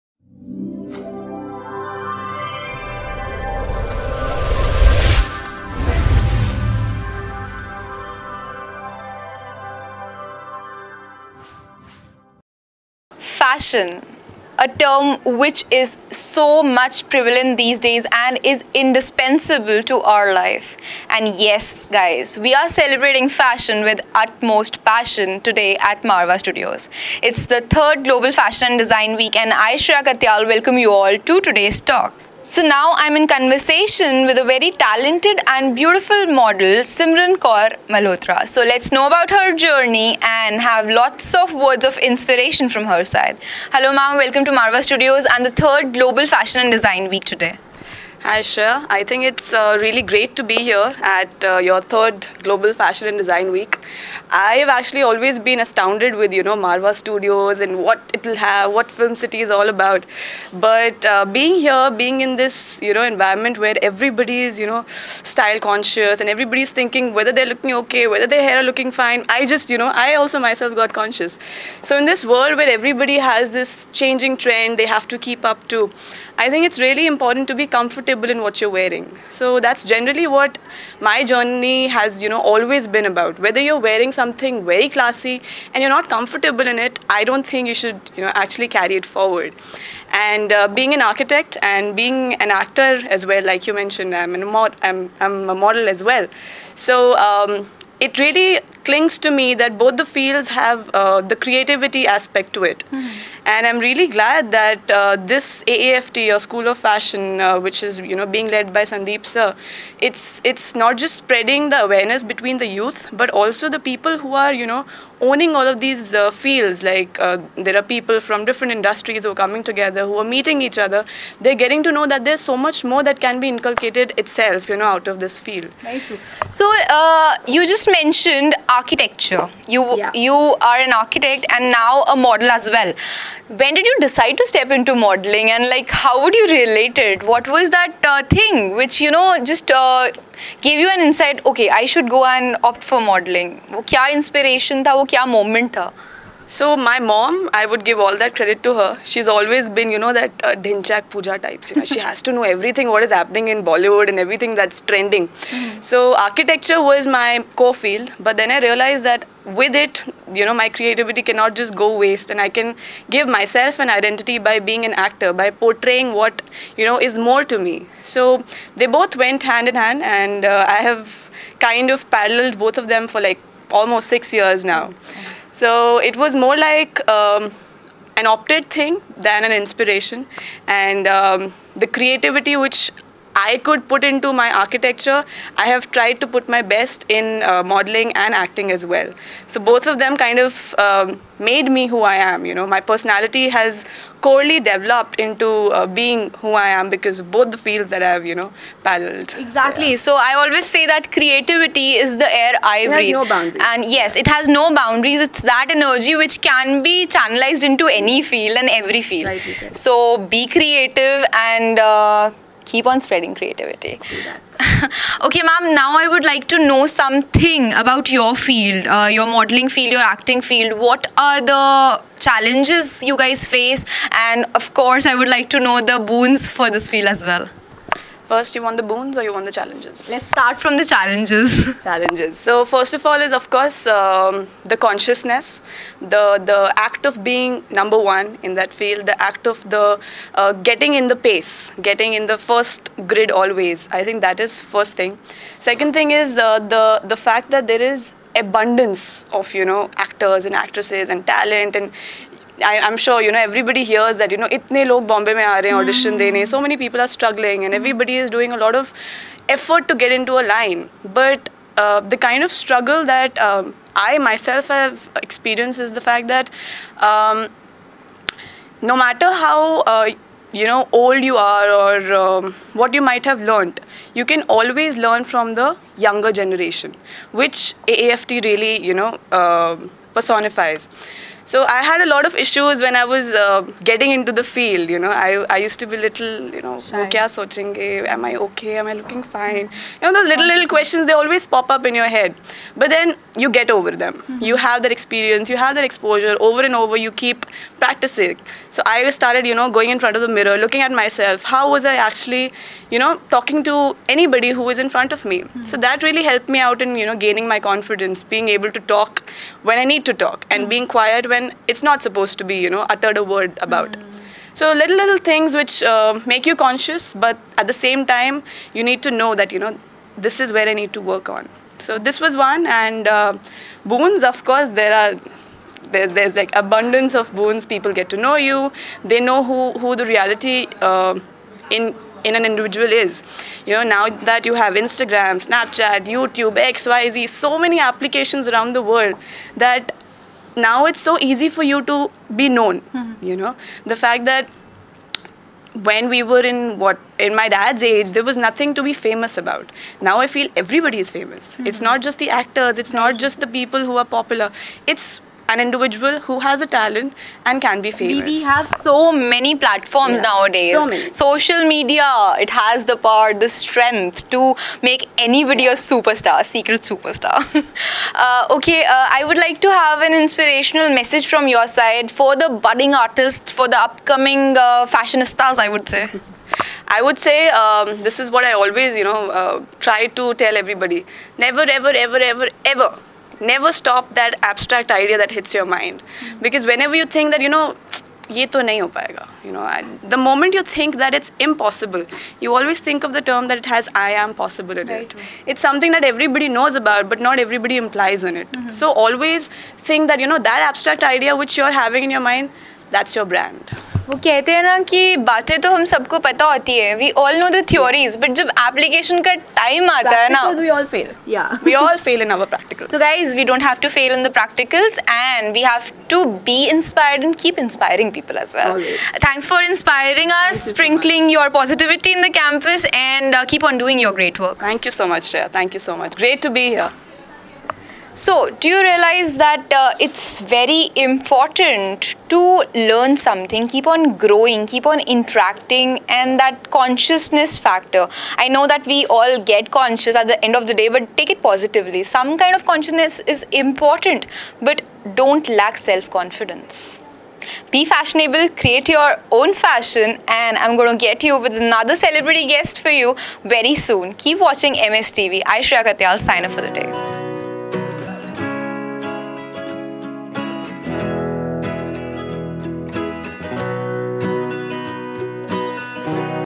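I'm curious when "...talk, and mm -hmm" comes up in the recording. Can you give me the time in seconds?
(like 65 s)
310 s.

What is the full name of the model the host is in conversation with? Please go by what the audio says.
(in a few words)
Simran Kaur Malhotra.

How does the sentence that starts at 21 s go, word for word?
And yes, guys, we are celebrating fashion with utmost passion today at Marwah Studios.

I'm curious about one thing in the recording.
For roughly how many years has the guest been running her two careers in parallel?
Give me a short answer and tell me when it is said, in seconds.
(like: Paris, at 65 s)
6 years, at 174 s.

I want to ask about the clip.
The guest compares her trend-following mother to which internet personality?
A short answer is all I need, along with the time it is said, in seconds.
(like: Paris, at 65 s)
Dhinchak Pooja, at 150 s.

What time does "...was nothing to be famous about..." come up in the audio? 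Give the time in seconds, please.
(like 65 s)
348 s.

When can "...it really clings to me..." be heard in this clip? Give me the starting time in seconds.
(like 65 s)
98 s.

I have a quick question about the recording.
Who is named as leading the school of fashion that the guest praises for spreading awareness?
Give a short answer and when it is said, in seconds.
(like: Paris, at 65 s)
Sandeep, at 108 s.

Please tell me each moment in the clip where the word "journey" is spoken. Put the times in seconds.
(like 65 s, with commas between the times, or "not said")
39 s, 81 s.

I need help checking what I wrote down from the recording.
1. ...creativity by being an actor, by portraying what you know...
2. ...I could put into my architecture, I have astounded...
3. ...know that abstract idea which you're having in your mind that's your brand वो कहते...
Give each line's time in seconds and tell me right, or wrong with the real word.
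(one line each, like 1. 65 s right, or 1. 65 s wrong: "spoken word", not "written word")
1. 163 s wrong: "identity", not "creativity"
2. 183 s wrong: "tried", not "astounded"
3. 400 s right.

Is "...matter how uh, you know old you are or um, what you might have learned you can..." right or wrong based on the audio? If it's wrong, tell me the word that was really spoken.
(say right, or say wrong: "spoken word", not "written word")
right.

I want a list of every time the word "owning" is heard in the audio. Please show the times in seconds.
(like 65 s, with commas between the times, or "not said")
115 s.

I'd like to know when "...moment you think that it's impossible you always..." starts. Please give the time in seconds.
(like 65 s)
390 s.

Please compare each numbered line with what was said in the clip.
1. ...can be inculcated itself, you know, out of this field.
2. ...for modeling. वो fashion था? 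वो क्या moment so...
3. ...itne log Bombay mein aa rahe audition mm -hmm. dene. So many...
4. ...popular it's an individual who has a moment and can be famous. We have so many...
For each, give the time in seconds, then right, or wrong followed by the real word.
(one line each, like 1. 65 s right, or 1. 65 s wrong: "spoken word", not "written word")
1. 123 s right
2. 142 s wrong: "inspiration", not "fashion"
3. 254 s right
4. 354 s wrong: "talent", not "moment".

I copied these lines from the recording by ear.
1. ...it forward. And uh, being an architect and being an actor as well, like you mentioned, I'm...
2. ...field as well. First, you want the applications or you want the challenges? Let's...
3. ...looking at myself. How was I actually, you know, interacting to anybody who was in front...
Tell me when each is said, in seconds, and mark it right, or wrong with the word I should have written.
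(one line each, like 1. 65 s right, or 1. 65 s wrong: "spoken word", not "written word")
1. 88 s right
2. 226 s wrong: "boons", not "applications"
3. 300 s wrong: "talking", not "interacting".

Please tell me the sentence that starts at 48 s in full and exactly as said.
Hi Shreeya, I think it's uh, really great to be here at uh, your third Global Fashion and Design Week.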